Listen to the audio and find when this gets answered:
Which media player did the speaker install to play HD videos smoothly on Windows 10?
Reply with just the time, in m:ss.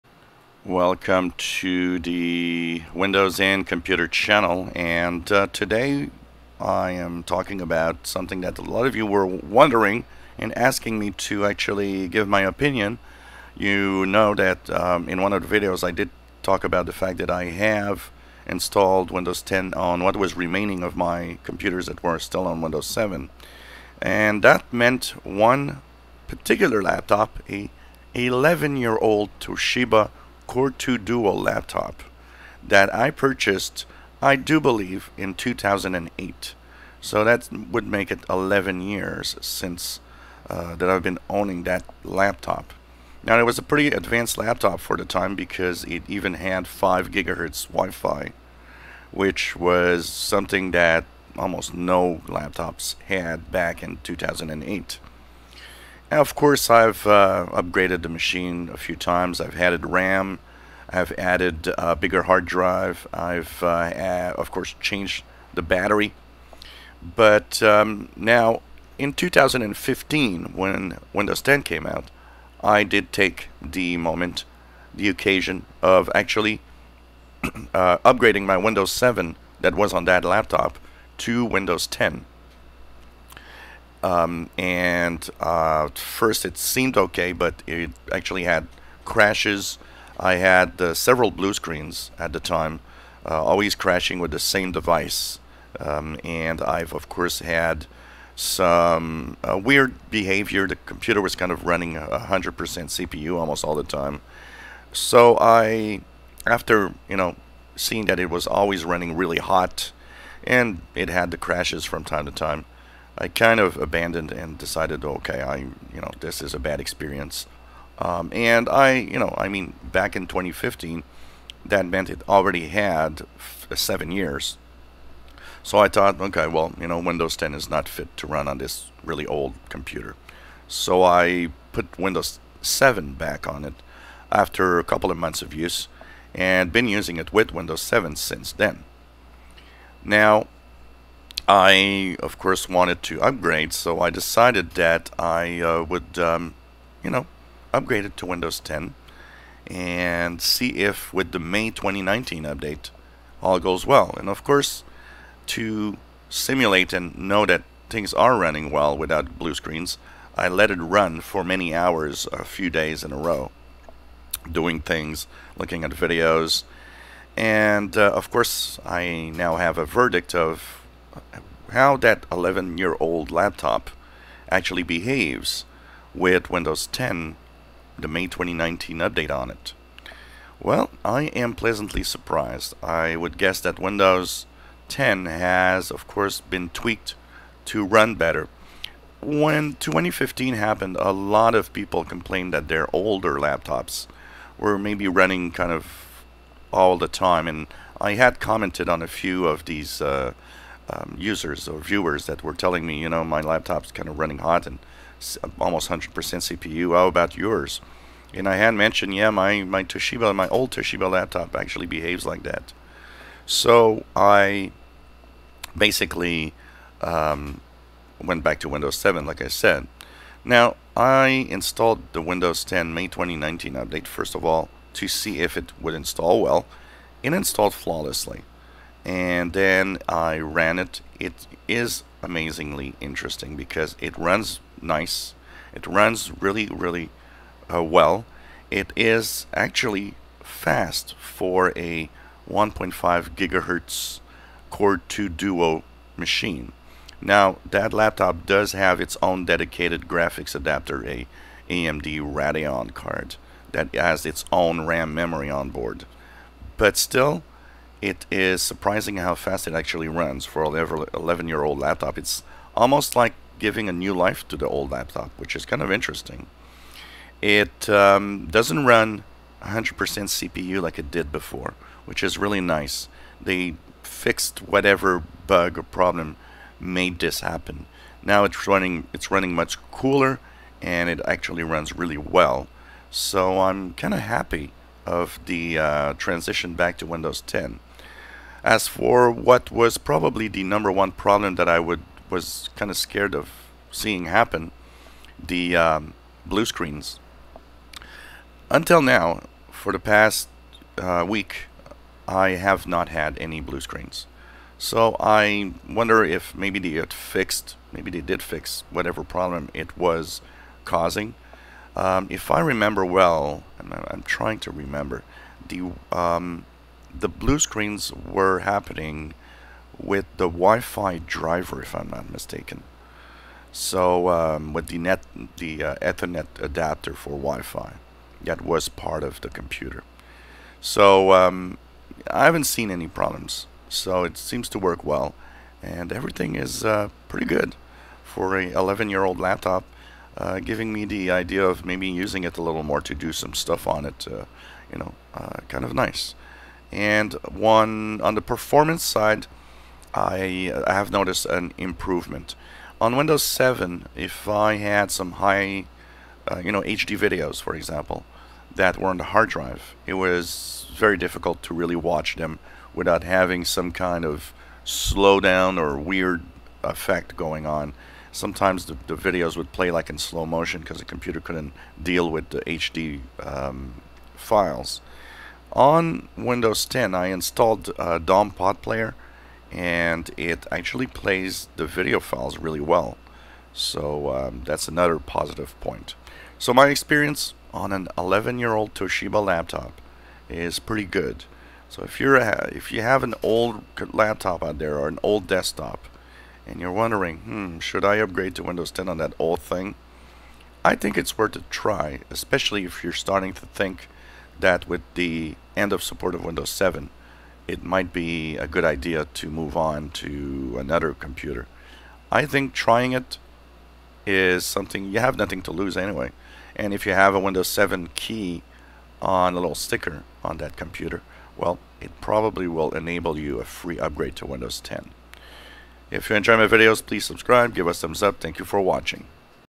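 6:18.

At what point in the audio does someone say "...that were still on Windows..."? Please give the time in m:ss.
0:21.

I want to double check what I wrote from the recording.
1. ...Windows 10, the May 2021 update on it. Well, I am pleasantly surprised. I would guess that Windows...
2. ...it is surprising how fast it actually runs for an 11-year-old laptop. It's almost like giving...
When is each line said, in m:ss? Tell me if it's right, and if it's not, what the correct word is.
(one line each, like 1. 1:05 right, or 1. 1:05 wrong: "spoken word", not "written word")
1. 2:56 wrong: "2019", not "2021"
2. 4:18 right.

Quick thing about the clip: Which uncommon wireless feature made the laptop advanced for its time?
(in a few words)
5 gigahertz Wi-Fi.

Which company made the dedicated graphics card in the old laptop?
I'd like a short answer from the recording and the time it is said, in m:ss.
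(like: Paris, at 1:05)
AMD, at 4:11.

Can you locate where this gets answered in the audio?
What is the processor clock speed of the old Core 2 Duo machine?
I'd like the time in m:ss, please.
4:02.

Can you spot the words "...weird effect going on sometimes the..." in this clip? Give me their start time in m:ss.
6:05.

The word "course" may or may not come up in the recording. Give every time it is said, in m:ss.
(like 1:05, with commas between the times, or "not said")
0:56, 1:04, 1:37, 2:22, 2:34, 2:48, 3:06.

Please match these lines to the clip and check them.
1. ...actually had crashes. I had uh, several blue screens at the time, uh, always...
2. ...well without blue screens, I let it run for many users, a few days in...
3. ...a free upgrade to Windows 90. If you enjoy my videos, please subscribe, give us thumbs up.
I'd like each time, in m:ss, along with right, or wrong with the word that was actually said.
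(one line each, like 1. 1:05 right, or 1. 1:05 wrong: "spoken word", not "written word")
1. 1:28 right
2. 2:38 wrong: "hours", not "users"
3. 7:03 wrong: "10", not "90".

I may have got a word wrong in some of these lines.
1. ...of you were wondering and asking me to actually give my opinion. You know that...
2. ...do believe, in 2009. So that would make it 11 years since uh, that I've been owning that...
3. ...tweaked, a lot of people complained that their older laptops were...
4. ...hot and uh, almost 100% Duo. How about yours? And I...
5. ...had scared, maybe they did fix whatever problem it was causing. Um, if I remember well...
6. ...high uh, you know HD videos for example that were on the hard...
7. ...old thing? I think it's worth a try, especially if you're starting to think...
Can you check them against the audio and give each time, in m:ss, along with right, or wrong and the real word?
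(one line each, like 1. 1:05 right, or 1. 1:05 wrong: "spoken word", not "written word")
1. 0:08 right
2. 0:34 wrong: "2008", not "2009"
3. 3:10 wrong: "happened", not "tweaked"
4. 3:24 wrong: "CPU", not "Duo"
5. 5:06 wrong: "fixed", not "scared"
6. 5:55 right
7. 6:39 right.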